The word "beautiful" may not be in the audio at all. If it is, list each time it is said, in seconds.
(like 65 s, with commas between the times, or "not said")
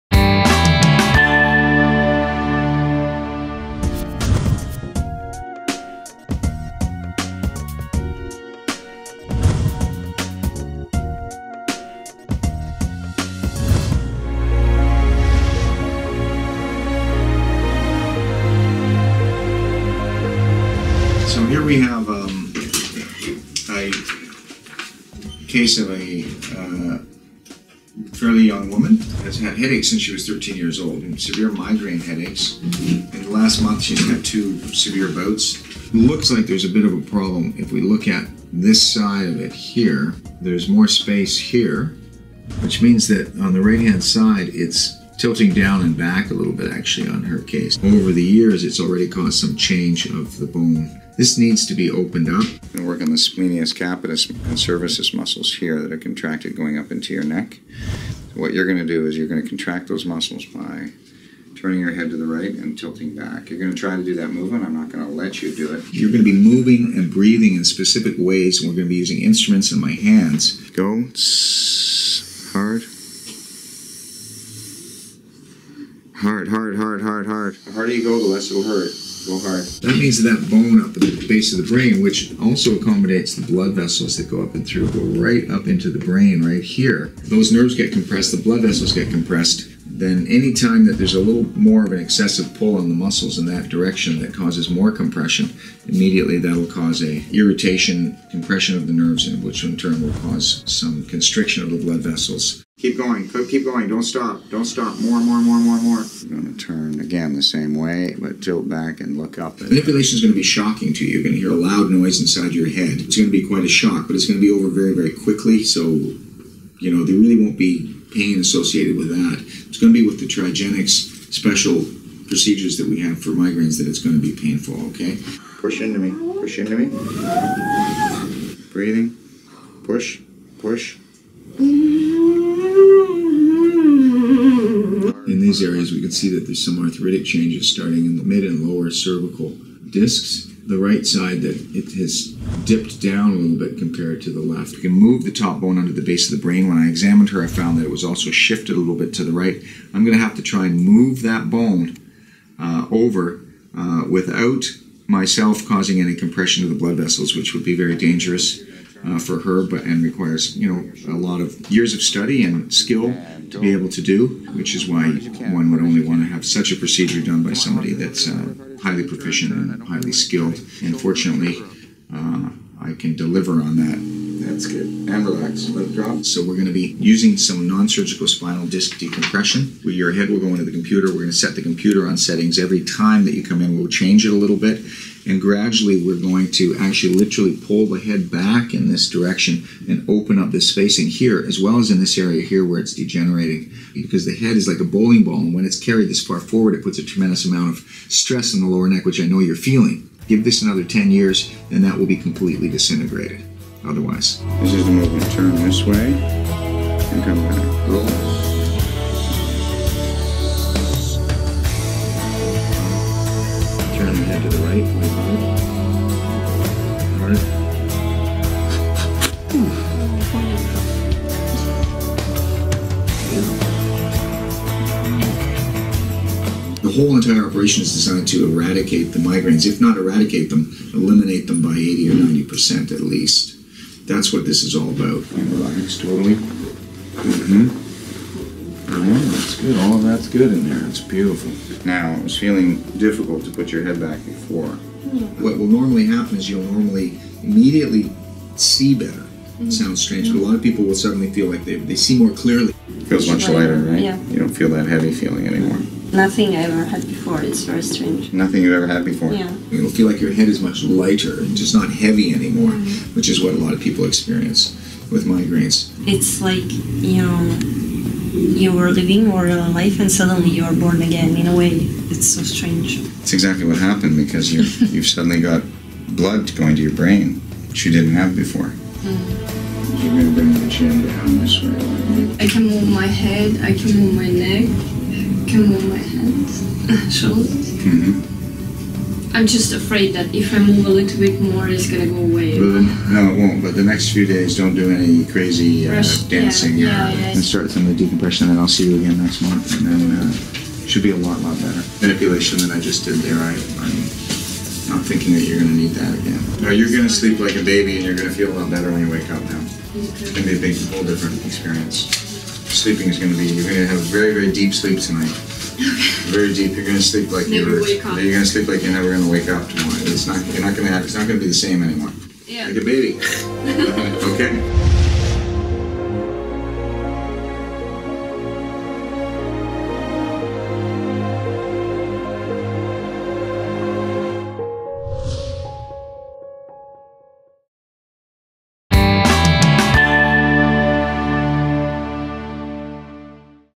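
240 s.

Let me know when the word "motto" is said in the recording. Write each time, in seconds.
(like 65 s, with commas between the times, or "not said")
not said.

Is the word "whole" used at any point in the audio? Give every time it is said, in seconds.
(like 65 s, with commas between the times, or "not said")
226 s, 310 s.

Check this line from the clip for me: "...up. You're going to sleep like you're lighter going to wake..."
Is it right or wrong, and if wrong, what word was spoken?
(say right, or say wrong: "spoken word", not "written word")
wrong: "never", not "lighter".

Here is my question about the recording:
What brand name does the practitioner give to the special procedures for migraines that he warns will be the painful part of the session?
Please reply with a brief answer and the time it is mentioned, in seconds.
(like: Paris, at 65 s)
Trigenics, at 120 s.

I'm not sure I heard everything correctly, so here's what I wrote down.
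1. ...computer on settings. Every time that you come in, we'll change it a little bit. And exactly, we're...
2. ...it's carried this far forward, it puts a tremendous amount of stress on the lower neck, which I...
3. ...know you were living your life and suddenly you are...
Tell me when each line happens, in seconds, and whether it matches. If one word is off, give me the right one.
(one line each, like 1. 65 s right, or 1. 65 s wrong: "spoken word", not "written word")
1. 181 s wrong: "gradually", not "exactly"
2. 195 s right
3. 267 s right.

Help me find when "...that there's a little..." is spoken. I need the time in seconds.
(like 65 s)
90 s.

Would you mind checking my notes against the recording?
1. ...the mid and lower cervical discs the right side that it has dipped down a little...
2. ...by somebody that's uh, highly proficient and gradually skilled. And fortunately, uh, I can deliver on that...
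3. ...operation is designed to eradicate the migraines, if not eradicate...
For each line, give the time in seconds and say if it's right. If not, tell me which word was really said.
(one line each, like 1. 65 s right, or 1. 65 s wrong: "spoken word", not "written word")
1. 138 s right
2. 167 s wrong: "highly", not "gradually"
3. 227 s right.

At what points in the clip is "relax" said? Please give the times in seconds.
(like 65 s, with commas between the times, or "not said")
175 s, 235 s.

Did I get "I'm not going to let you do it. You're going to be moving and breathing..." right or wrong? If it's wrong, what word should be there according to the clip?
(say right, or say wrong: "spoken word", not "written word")
right.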